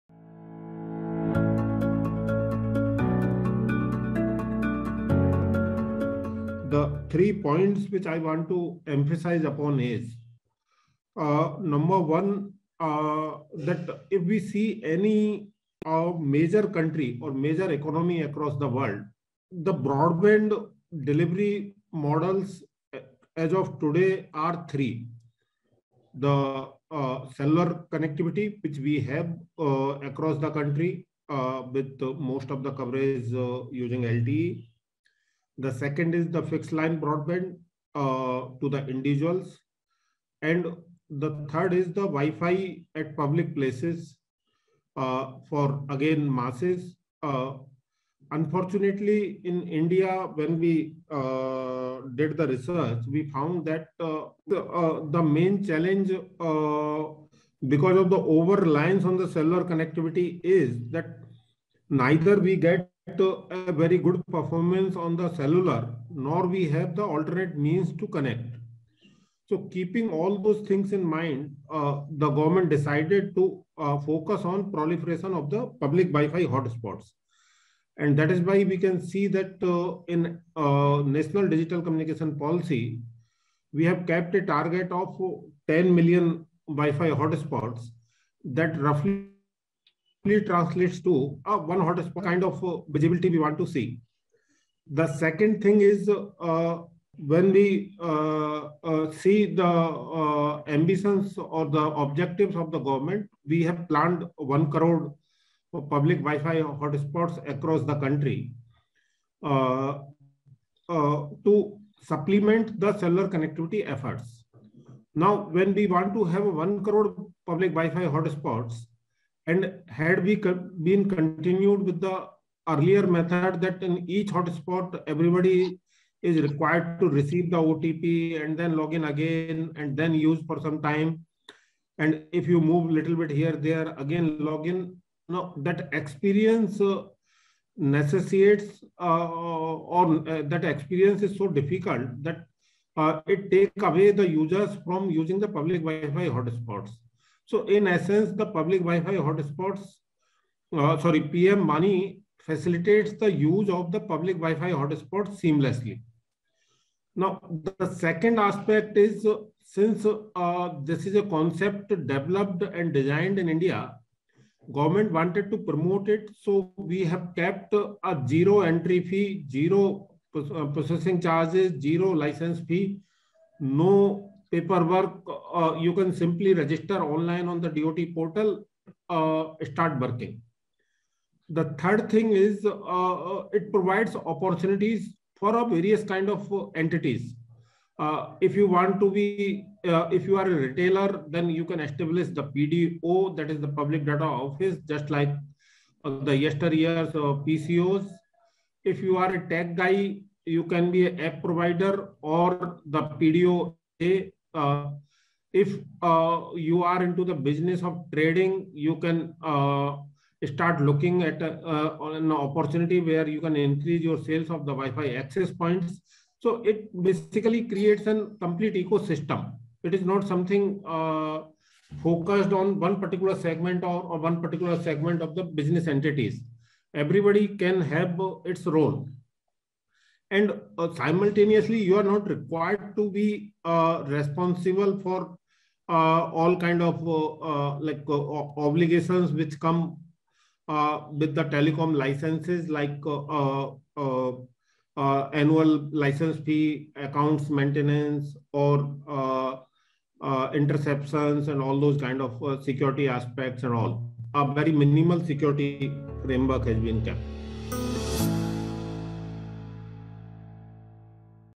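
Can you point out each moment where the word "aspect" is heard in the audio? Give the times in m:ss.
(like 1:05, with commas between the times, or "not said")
2:38, 4:13.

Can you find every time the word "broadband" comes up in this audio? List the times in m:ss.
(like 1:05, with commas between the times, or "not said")
0:19, 0:36.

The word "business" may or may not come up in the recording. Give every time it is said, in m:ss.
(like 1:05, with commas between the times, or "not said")
3:27, 3:45.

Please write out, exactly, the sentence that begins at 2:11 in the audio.
And if you move a little bit here, there, again, log in.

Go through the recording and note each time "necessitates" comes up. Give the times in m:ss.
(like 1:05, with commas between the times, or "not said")
2:17.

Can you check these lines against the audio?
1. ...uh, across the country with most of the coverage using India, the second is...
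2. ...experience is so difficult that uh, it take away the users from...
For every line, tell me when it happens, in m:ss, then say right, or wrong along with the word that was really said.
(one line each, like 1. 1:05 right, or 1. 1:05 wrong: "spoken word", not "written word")
1. 0:29 wrong: "LTE", not "India"
2. 2:20 right.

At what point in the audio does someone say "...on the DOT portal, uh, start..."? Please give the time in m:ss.
2:57.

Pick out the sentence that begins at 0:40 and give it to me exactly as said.
And the third is the Wi-Fi at public places uh, for again masses.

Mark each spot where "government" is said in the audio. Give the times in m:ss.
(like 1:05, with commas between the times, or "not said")
1:12, 1:42, 2:44.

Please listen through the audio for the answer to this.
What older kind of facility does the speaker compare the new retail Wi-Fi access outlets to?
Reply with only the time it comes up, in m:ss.
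3:17.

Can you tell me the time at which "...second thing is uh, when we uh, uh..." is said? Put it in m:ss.
1:35.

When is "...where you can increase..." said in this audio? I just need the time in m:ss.
3:33.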